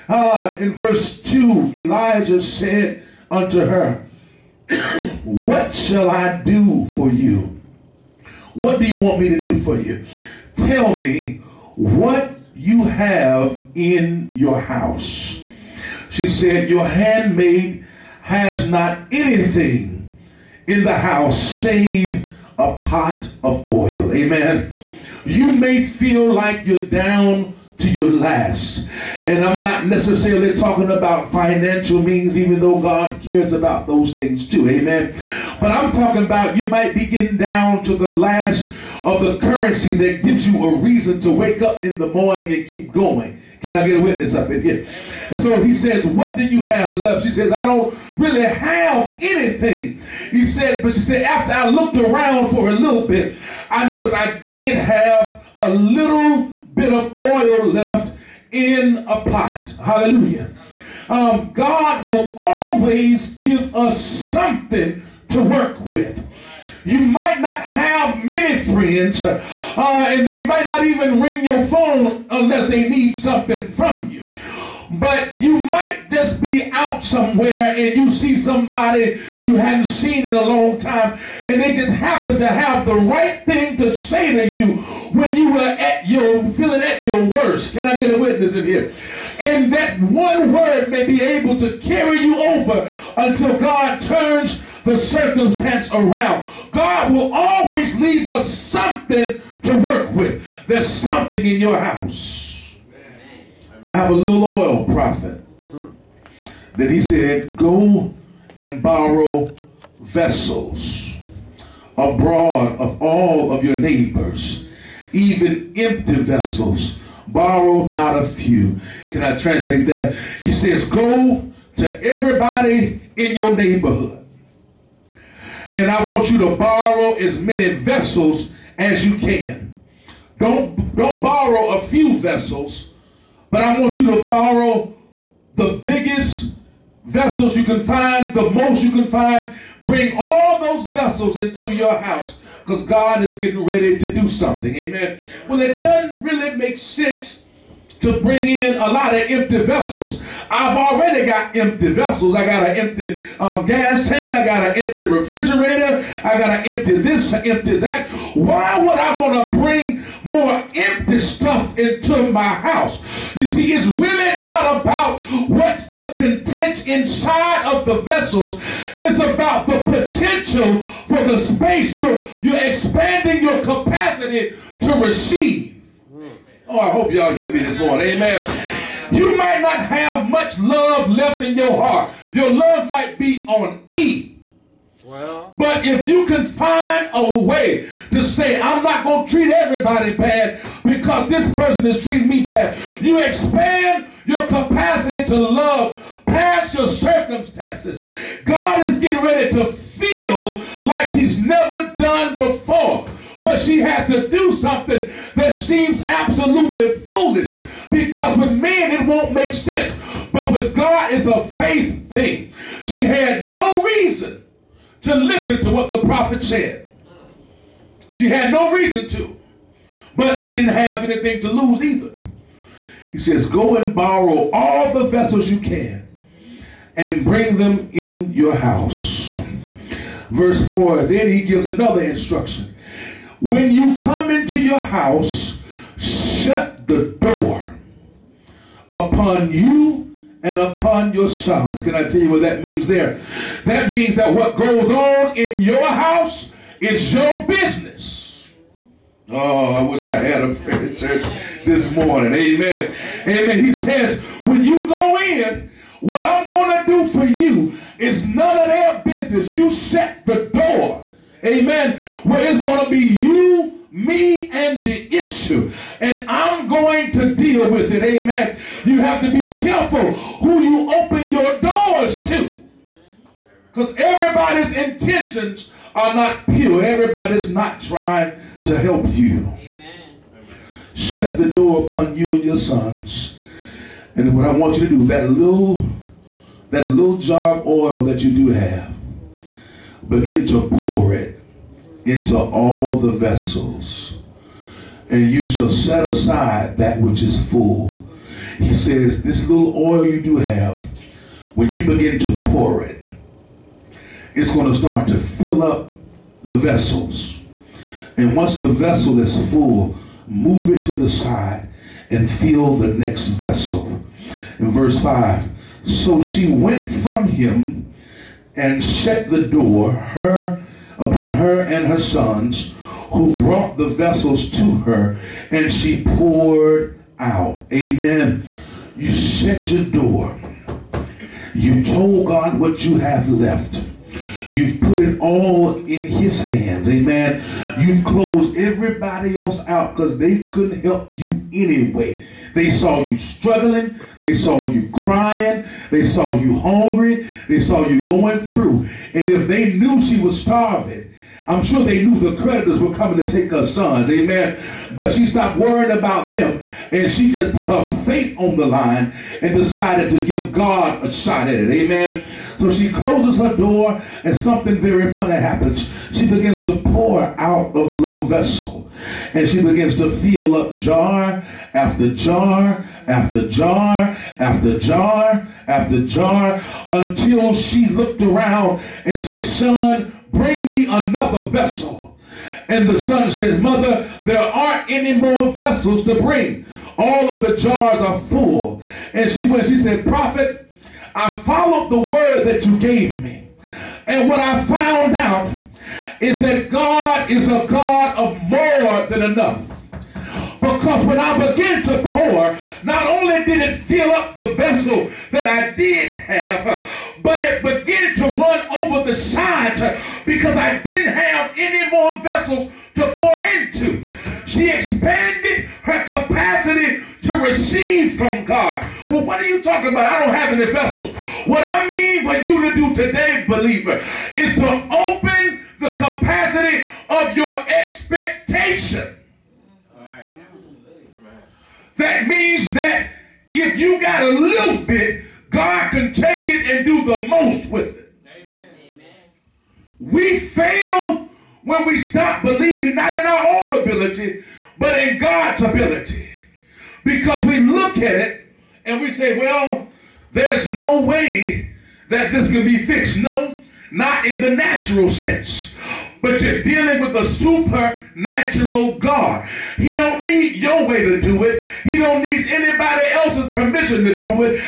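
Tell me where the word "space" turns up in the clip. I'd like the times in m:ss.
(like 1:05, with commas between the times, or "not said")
2:51.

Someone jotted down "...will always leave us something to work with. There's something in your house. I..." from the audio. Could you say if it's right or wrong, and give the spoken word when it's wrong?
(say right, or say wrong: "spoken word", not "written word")
right.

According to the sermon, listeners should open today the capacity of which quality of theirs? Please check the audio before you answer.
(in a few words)
expectation.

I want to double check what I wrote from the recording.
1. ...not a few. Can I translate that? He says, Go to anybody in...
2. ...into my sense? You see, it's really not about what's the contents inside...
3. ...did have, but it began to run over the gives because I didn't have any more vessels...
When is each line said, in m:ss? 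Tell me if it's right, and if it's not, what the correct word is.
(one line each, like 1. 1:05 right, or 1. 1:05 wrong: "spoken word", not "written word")
1. 1:57 wrong: "everybody", not "anybody"
2. 2:41 wrong: "house", not "sense"
3. 6:45 wrong: "sides", not "gives".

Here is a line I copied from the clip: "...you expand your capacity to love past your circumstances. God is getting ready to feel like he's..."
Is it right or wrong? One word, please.
right.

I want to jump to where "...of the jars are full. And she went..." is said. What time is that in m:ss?
6:27.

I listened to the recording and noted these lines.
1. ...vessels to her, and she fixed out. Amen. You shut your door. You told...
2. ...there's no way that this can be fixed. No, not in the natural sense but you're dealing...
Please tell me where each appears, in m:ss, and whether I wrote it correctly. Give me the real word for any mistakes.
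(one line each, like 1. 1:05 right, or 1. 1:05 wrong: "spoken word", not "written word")
1. 5:23 wrong: "poured", not "fixed"
2. 7:30 right.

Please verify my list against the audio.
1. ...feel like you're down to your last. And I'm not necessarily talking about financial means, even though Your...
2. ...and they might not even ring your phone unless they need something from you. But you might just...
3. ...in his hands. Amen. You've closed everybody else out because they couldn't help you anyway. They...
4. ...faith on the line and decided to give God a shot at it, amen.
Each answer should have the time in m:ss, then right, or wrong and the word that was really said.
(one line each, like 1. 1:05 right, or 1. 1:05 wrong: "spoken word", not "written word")
1. 0:25 wrong: "God", not "Your"
2. 1:09 right
3. 5:35 right
4. 5:58 right.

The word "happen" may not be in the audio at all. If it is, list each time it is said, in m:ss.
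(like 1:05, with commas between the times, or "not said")
1:21, 6:05.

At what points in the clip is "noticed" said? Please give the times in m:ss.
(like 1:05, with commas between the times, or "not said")
0:53.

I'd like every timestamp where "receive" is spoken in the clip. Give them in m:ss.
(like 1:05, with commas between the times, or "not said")
2:55, 6:57.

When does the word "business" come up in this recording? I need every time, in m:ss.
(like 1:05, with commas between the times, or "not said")
4:07, 4:19.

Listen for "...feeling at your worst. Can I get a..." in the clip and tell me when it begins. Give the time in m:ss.
1:26.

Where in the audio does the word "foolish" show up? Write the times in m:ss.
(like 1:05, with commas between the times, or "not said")
3:26.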